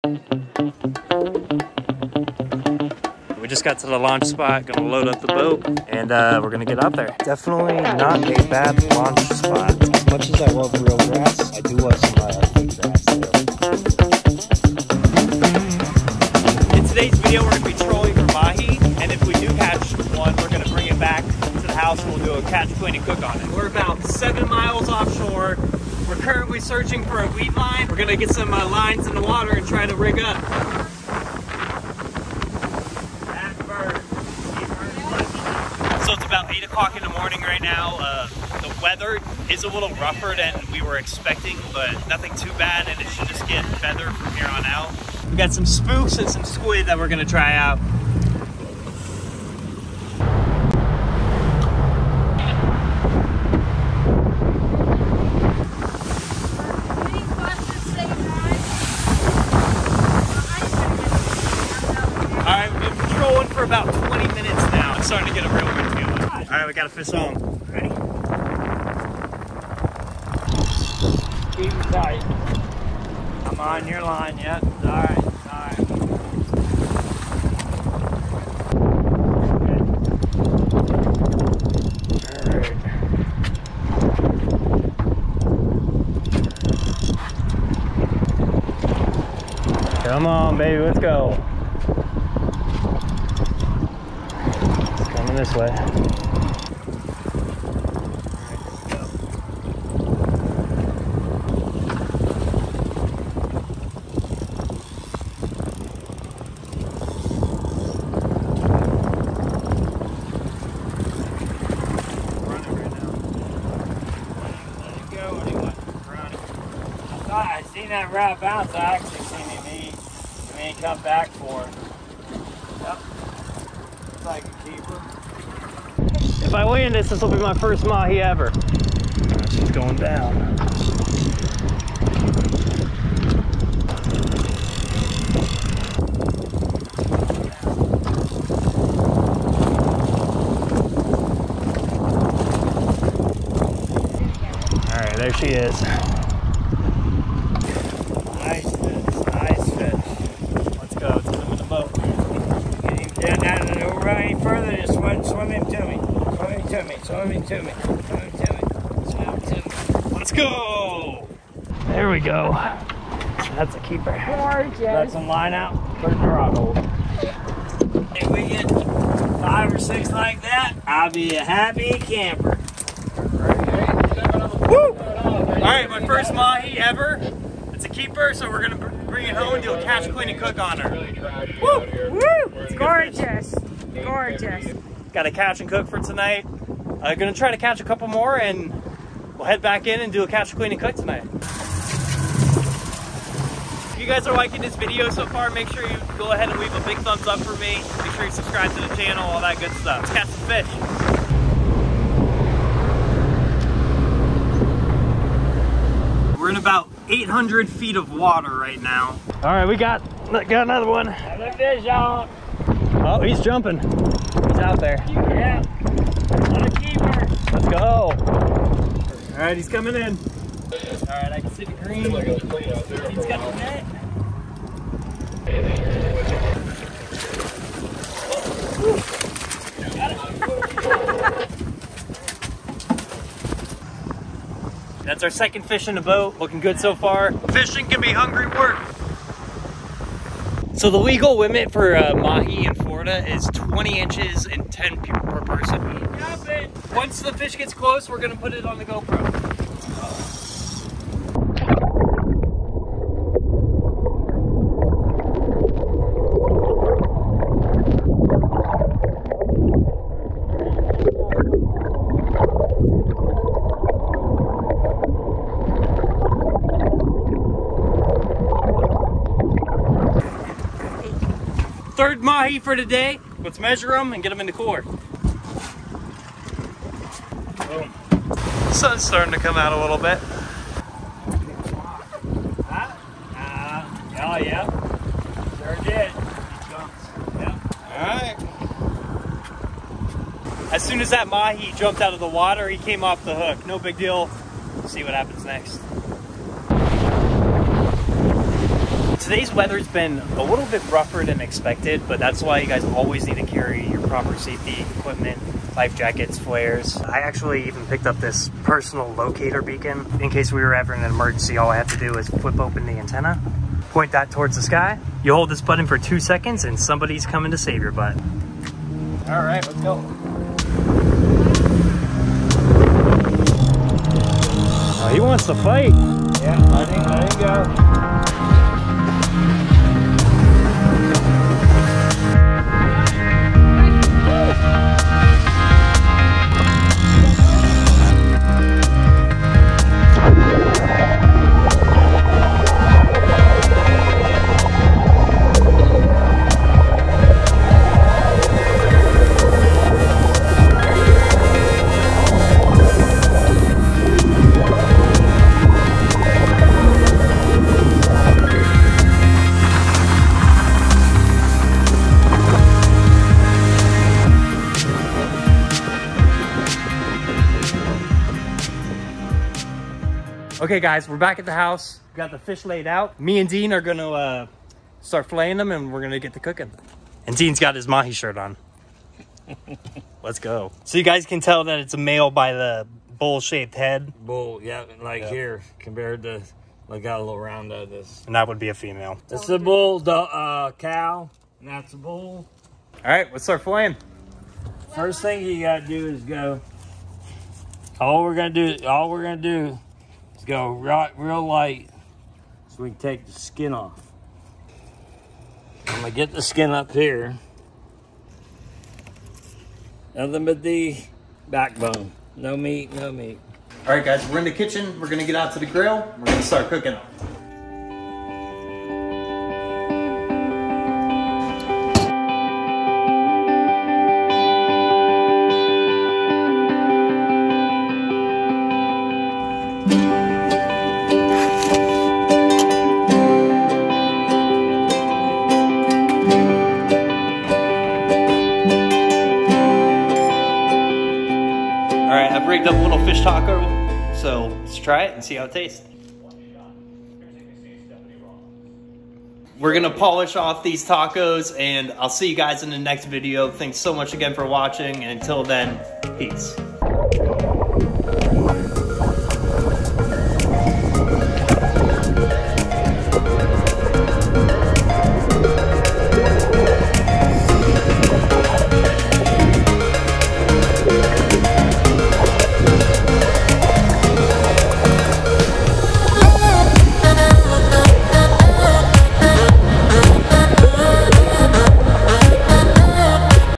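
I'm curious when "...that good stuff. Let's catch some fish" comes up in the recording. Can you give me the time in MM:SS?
03:19.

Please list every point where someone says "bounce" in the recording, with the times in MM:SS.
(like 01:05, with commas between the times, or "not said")
01:58.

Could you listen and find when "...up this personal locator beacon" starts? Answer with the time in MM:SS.
05:08.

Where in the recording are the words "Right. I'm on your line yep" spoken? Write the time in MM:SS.
01:11.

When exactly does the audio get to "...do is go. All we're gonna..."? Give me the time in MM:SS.
06:35.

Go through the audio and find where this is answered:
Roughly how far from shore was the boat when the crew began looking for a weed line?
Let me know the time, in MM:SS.
00:24.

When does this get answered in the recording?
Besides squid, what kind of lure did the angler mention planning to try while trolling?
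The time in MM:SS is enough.
00:45.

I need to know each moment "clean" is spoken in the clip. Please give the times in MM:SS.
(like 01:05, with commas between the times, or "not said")
00:22, 03:00, 03:10.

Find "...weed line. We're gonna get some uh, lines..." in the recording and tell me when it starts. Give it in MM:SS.
00:27.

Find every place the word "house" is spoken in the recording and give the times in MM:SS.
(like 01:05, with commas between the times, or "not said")
00:21, 06:11.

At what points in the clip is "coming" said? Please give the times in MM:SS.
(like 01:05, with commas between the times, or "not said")
01:35, 03:39, 05:17.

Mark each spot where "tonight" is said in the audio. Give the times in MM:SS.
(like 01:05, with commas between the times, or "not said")
03:05, 03:10.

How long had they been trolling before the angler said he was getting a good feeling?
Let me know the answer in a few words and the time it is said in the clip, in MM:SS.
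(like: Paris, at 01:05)
20 minutes, at 01:04.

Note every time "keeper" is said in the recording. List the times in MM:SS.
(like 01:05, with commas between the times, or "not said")
02:04, 02:43, 02:57, 03:36.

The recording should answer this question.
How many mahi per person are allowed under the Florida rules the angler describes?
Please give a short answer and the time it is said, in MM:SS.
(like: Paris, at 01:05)
10, at 04:04.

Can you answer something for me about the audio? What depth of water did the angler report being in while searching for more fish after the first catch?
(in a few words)
800 feet.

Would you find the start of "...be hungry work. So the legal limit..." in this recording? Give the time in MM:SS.
03:57.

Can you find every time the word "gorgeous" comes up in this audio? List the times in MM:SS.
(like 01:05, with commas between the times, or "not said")
02:44, 03:04.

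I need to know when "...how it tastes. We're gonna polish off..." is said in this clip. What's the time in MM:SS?
07:25.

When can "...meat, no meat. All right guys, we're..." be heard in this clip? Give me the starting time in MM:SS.
06:52.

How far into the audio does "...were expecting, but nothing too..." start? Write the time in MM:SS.
00:40.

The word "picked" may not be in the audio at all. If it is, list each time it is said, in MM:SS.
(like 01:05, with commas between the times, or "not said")
05:07.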